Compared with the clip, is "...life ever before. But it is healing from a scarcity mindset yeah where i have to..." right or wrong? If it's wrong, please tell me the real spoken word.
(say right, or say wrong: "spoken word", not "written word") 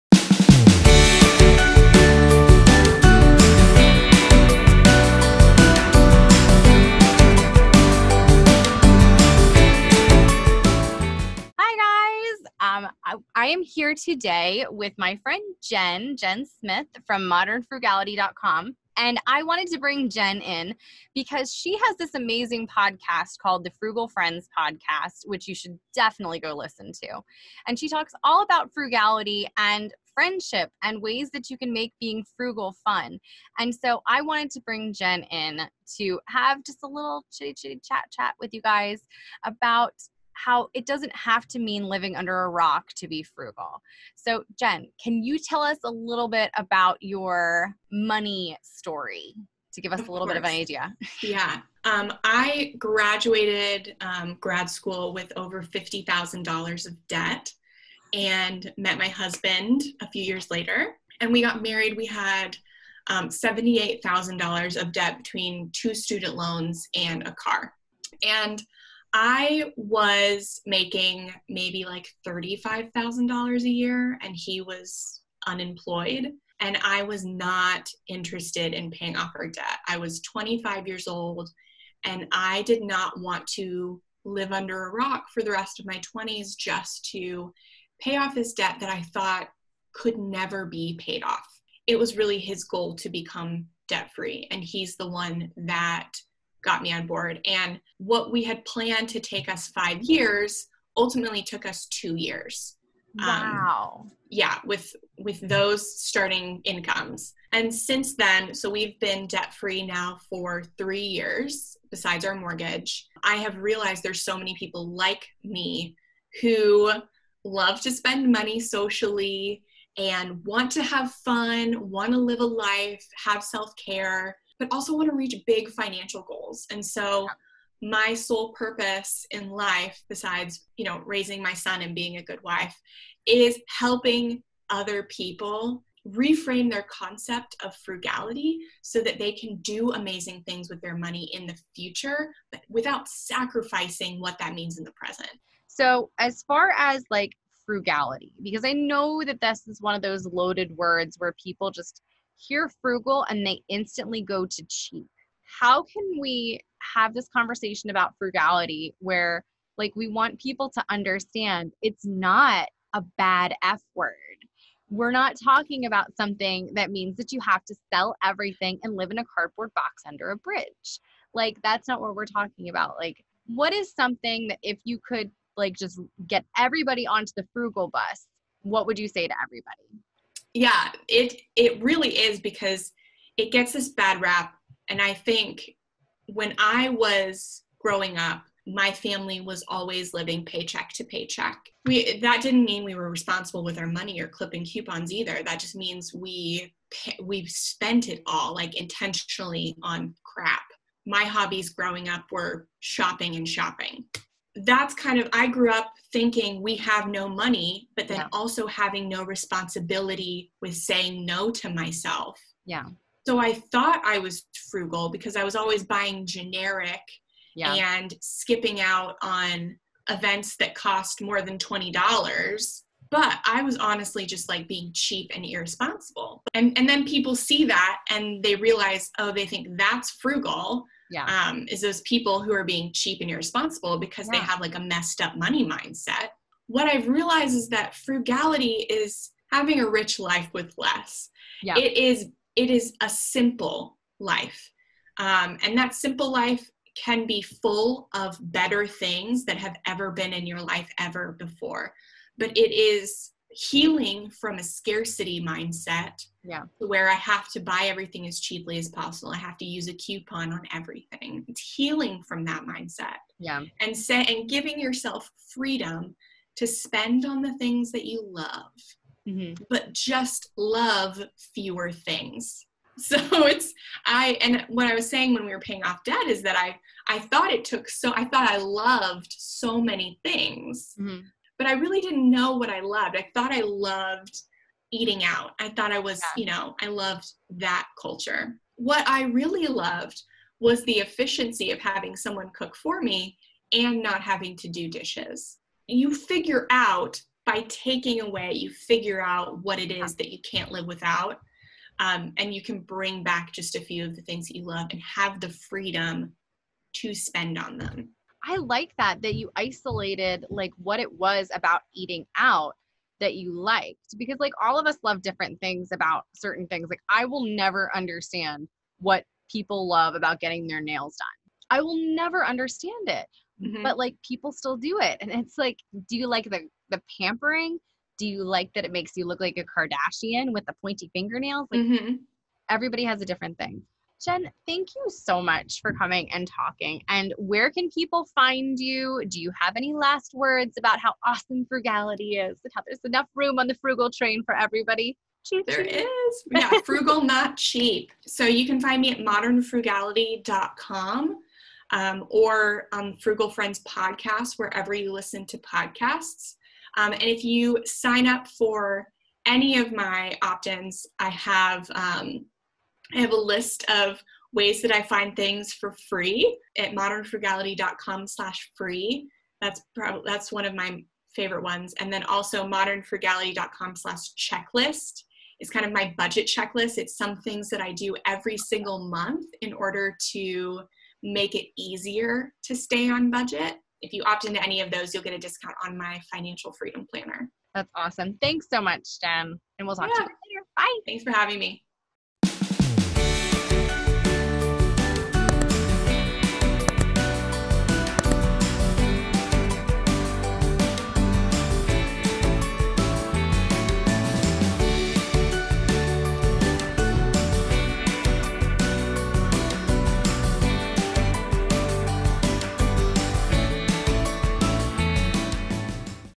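right.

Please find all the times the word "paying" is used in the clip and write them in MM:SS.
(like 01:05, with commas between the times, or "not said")
01:18, 04:35.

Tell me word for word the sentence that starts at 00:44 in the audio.
So, Jen, can you tell us a little bit about your money story to give us of a little course.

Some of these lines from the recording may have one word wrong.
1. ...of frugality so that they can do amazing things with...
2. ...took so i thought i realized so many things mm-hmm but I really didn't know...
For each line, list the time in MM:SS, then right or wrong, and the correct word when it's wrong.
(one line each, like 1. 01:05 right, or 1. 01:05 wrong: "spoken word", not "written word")
1. 02:17 right
2. 04:37 wrong: "loved", not "realized".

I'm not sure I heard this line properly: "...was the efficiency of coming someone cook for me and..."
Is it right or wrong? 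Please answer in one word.
wrong.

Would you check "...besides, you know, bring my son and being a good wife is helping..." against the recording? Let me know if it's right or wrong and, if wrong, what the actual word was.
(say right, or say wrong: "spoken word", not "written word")
wrong: "raising", not "bring".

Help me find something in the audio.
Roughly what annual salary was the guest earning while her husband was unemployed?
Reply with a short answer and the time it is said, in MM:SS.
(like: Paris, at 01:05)
$35,000, at 01:12.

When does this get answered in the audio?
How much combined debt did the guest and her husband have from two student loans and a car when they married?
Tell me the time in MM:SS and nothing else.
01:03.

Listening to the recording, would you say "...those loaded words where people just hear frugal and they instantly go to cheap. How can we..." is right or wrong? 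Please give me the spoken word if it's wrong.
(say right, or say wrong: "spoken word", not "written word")
right.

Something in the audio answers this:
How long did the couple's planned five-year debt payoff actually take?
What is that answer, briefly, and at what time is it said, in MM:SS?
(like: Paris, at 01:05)
2 years, at 01:41.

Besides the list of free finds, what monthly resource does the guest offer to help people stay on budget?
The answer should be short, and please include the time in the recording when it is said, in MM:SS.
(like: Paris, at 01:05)
budget checklist, at 06:16.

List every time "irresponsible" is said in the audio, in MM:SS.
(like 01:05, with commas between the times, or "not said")
03:45, 03:53.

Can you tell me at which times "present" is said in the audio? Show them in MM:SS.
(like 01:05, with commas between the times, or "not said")
02:24.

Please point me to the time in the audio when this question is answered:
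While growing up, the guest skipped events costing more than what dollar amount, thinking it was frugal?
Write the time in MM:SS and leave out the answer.
03:41.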